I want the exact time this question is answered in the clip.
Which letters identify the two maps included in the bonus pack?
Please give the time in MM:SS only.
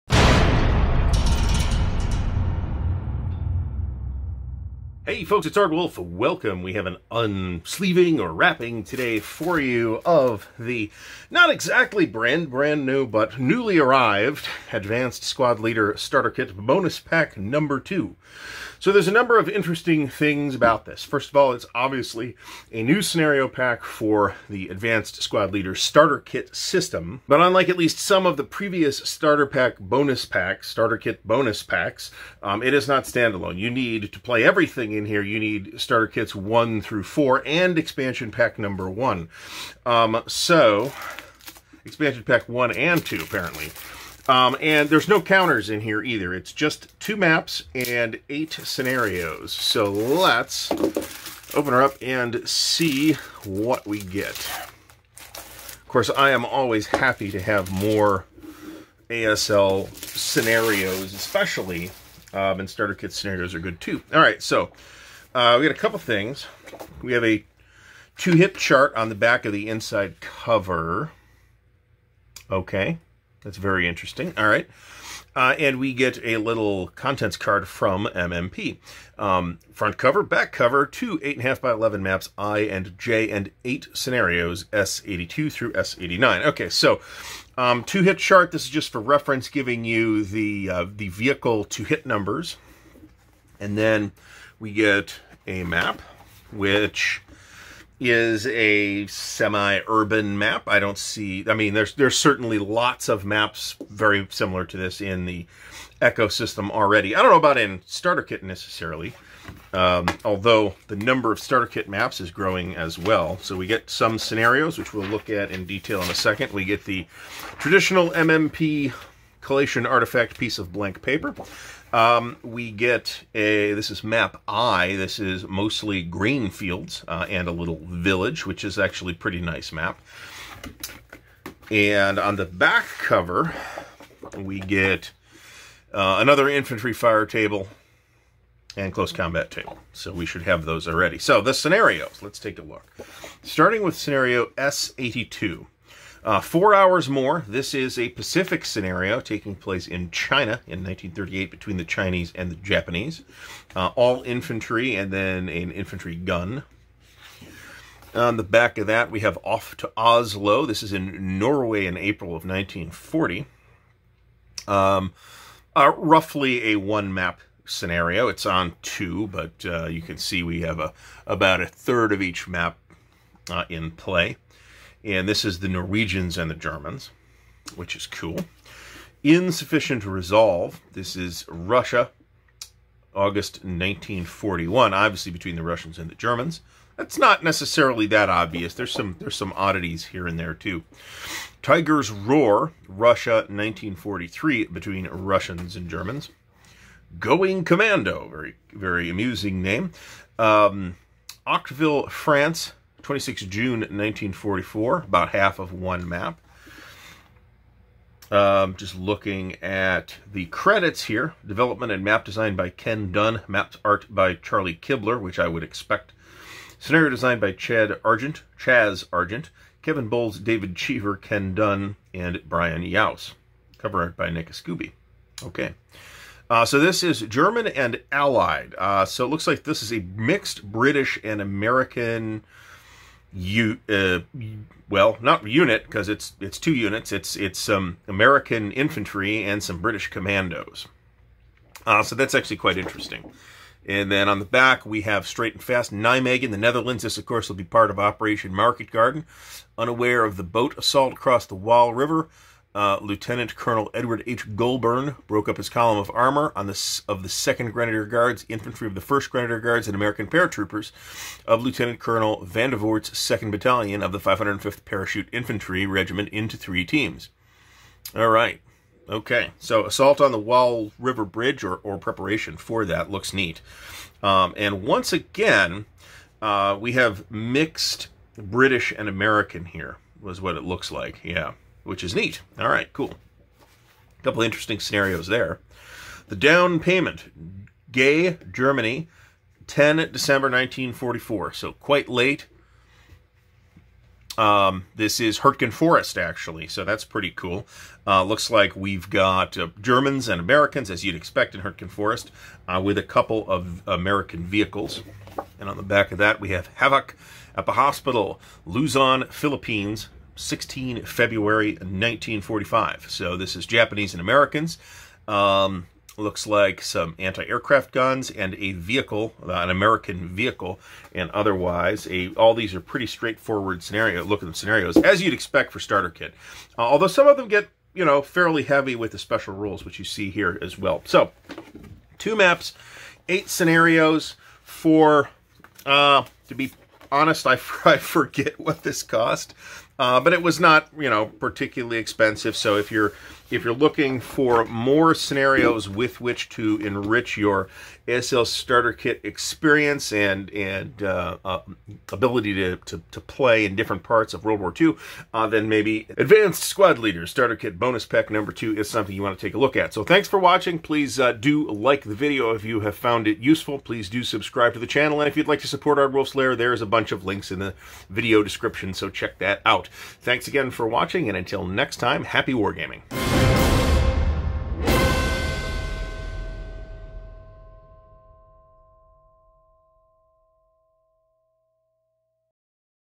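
01:22.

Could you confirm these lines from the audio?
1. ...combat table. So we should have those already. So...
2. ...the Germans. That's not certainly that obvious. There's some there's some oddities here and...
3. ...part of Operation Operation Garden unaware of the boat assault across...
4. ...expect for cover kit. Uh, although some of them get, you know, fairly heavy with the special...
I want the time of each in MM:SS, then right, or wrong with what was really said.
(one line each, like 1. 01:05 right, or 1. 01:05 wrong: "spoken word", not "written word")
1. 02:19 right
2. 03:06 wrong: "necessarily", not "certainly"
3. 04:07 wrong: "Market", not "Operation"
4. 05:25 wrong: "starter", not "cover".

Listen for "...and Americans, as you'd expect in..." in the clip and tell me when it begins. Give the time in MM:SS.
05:00.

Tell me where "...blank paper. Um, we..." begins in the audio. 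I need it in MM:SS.
02:00.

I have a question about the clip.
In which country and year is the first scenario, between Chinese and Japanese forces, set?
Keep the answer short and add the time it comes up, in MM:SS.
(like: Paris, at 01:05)
China, 1938, at 02:30.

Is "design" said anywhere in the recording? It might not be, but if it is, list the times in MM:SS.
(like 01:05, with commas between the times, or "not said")
03:32, 03:37.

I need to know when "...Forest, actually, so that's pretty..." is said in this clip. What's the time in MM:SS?
04:55.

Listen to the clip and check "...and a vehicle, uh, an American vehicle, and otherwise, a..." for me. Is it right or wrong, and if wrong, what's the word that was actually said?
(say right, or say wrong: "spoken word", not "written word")
right.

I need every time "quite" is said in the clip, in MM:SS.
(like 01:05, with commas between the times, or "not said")
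04:02, 04:51.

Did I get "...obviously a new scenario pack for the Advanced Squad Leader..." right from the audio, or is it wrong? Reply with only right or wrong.
right.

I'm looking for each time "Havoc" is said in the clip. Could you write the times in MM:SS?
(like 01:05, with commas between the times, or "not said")
05:06.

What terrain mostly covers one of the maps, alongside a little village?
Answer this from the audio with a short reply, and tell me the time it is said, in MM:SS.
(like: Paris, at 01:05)
Grain fields, at 02:06.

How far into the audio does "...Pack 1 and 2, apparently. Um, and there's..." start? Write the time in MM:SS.
00:42.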